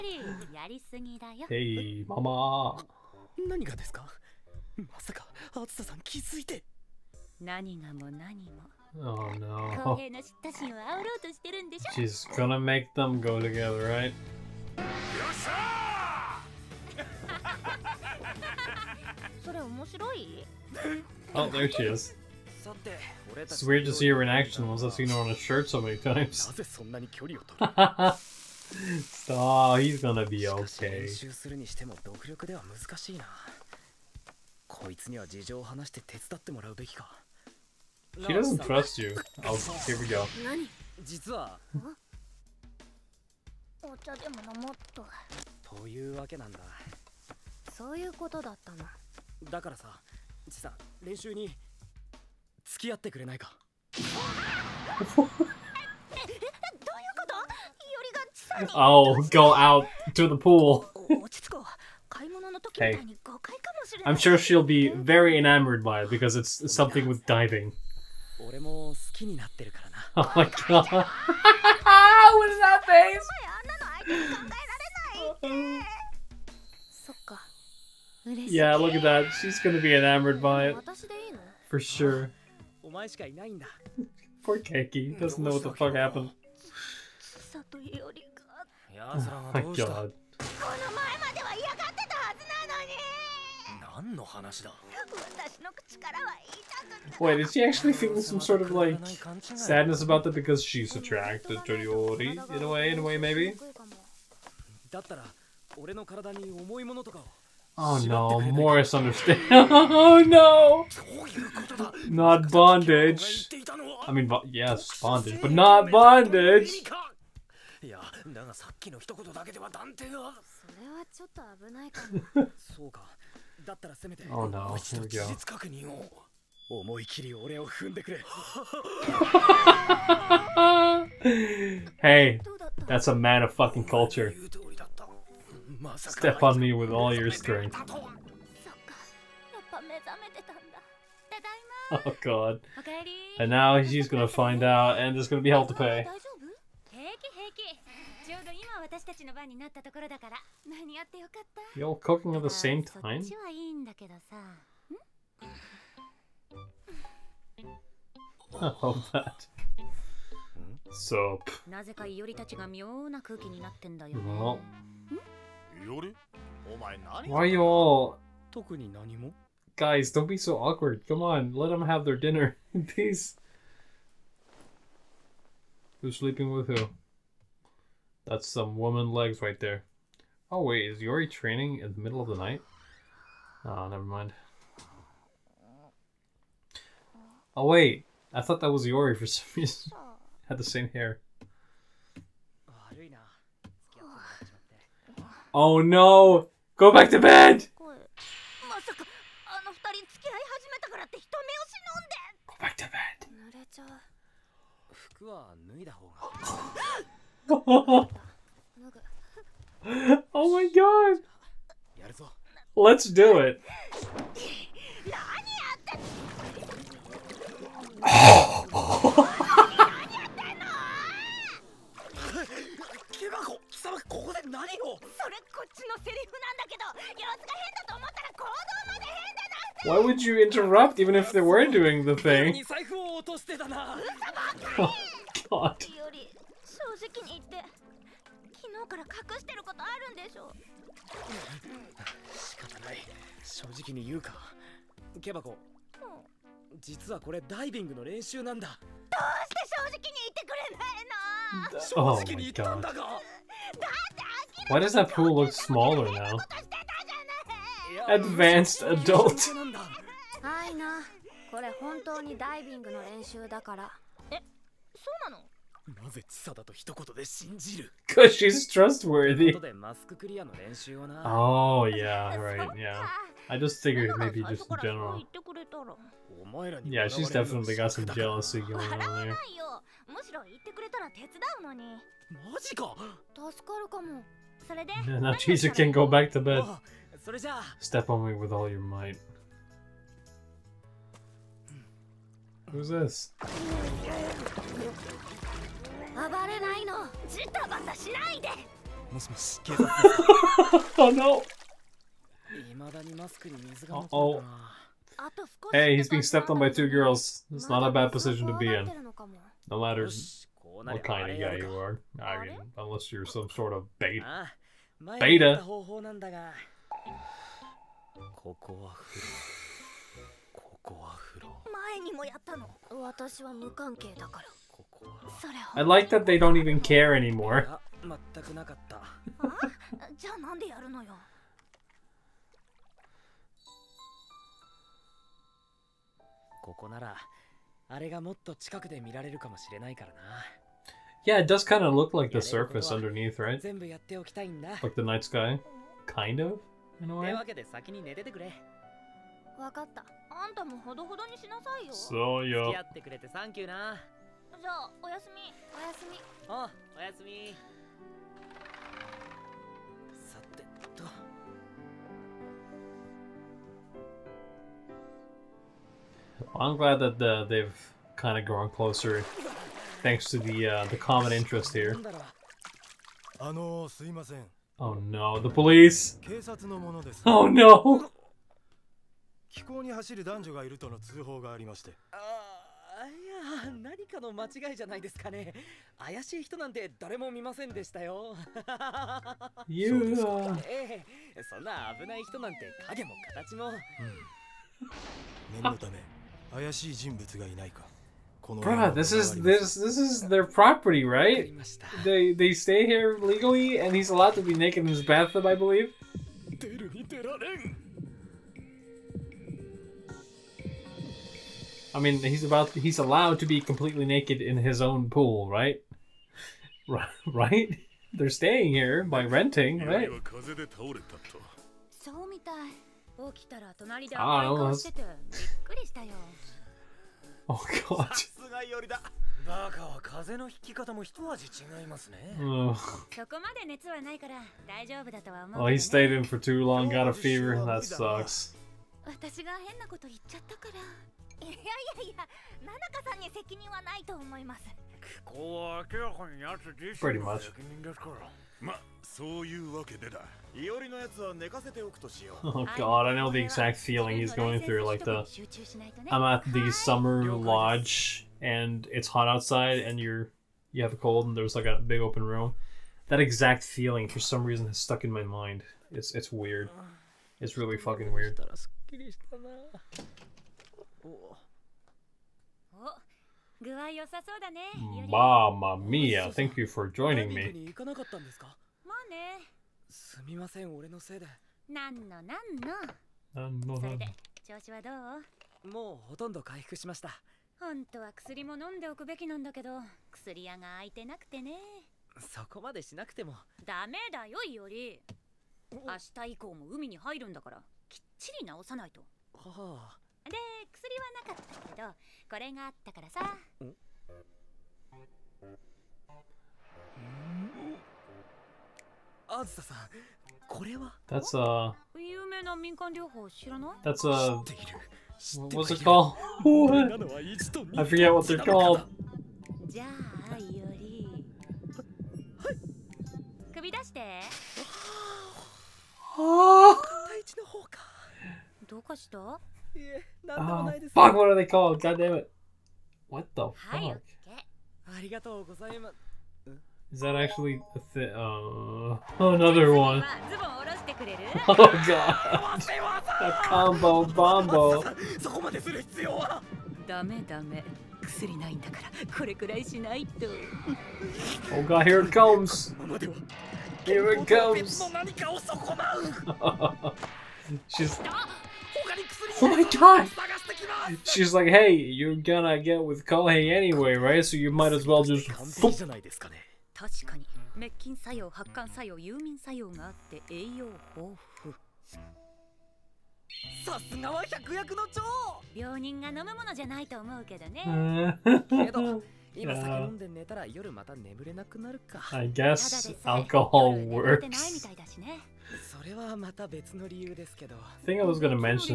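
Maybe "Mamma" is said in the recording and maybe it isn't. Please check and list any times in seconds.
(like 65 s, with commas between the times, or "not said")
475 s.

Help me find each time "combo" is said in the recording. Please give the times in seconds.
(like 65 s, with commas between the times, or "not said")
543 s.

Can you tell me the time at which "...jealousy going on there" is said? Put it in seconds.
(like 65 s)
278 s.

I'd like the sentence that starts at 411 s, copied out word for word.
I mean, he's about he's allowed to be completely naked in his own pool, right?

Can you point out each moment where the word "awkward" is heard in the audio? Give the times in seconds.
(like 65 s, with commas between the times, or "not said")
170 s.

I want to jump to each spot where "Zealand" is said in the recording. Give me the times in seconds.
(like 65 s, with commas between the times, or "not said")
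not said.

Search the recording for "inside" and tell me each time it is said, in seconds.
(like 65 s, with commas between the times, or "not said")
not said.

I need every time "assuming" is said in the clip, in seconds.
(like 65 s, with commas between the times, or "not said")
not said.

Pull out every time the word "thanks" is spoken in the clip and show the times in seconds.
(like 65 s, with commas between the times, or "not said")
370 s, 476 s.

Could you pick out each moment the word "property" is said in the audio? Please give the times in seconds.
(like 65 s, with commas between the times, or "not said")
400 s.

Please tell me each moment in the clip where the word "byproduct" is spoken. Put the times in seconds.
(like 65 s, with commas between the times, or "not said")
not said.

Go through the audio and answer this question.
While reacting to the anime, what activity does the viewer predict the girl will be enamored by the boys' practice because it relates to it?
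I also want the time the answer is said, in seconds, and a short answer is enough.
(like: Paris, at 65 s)
Diving, at 67 s.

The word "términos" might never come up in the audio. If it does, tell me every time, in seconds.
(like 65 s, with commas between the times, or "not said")
not said.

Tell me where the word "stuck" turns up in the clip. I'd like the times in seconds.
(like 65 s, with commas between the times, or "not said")
464 s.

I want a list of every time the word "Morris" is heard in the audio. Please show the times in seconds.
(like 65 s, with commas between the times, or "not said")
108 s.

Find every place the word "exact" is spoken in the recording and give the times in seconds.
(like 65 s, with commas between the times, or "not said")
453 s, 463 s.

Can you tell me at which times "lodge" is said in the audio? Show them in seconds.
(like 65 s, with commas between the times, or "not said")
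457 s.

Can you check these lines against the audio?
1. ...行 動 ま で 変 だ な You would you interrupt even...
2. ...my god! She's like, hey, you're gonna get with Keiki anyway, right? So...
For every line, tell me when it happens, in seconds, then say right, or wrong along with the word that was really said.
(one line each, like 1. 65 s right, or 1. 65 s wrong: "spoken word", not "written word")
1. 228 s wrong: "Why", not "You"
2. 559 s wrong: "Kohei", not "Keiki".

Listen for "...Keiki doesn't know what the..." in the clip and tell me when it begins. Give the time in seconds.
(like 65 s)
84 s.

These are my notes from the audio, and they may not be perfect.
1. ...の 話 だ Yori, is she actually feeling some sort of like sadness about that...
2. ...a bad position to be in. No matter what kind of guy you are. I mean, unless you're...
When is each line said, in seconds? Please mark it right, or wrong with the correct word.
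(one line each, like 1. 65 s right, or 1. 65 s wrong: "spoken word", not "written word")
1. 94 s wrong: "Wait", not "Yori"
2. 307 s right.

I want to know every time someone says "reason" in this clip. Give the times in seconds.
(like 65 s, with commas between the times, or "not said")
189 s, 464 s.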